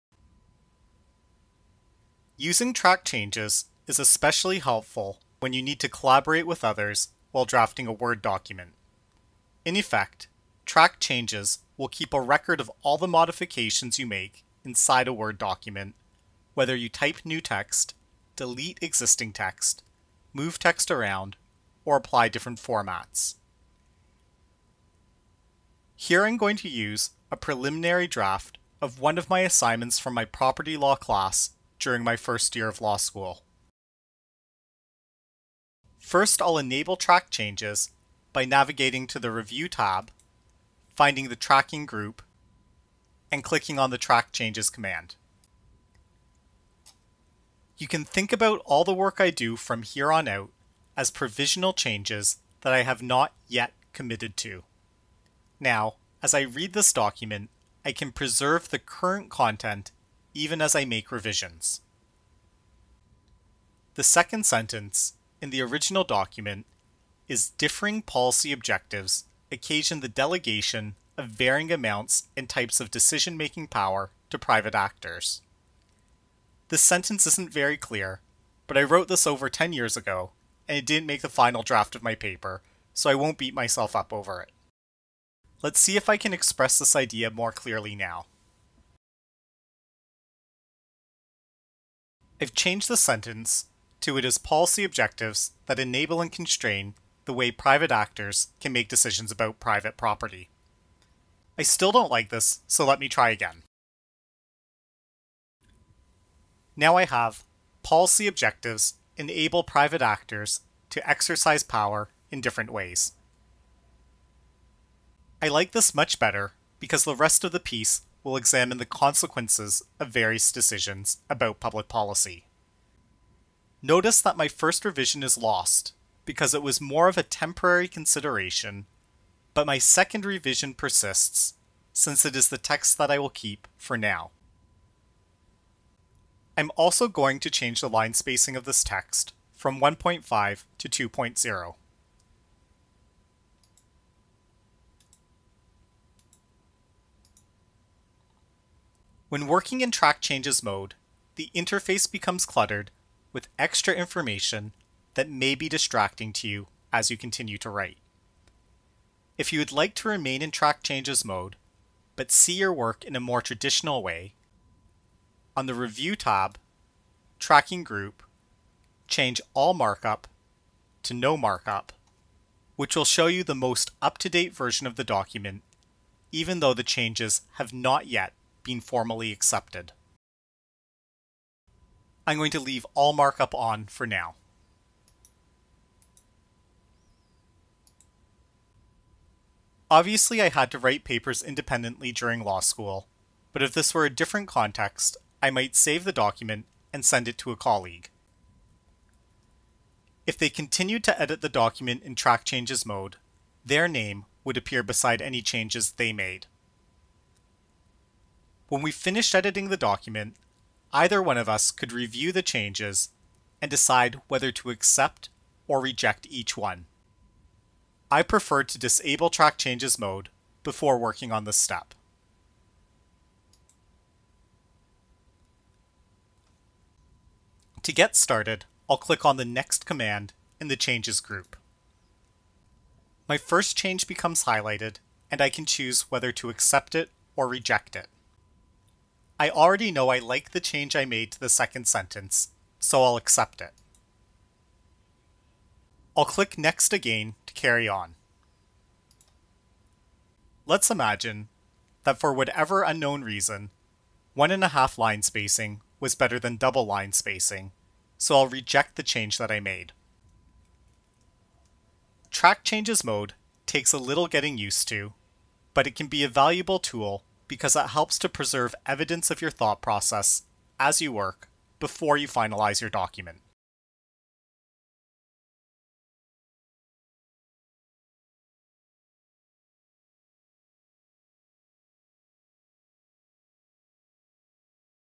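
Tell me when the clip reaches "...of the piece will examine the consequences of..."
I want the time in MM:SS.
01:57.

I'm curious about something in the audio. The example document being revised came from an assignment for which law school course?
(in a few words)
Property law.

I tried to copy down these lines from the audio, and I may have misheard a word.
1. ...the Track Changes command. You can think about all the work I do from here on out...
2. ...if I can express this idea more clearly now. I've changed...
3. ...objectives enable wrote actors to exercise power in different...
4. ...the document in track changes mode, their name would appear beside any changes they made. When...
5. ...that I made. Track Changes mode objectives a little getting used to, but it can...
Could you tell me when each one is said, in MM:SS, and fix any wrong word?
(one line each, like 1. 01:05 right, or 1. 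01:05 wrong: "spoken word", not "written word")
1. 00:43 right
2. 01:25 right
3. 01:48 wrong: "private", not "wrote"
4. 03:21 right
5. 04:19 wrong: "takes", not "objectives".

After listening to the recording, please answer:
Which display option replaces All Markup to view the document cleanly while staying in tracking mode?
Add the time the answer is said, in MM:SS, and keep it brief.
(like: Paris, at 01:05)
No Markup, at 02:51.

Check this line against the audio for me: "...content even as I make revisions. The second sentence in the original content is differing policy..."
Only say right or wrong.
wrong.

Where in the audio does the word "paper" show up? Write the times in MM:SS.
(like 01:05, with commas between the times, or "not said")
01:22, 03:11.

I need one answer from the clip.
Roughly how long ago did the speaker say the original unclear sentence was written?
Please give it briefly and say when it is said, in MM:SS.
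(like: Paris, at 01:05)
Over 10 years ago, at 01:19.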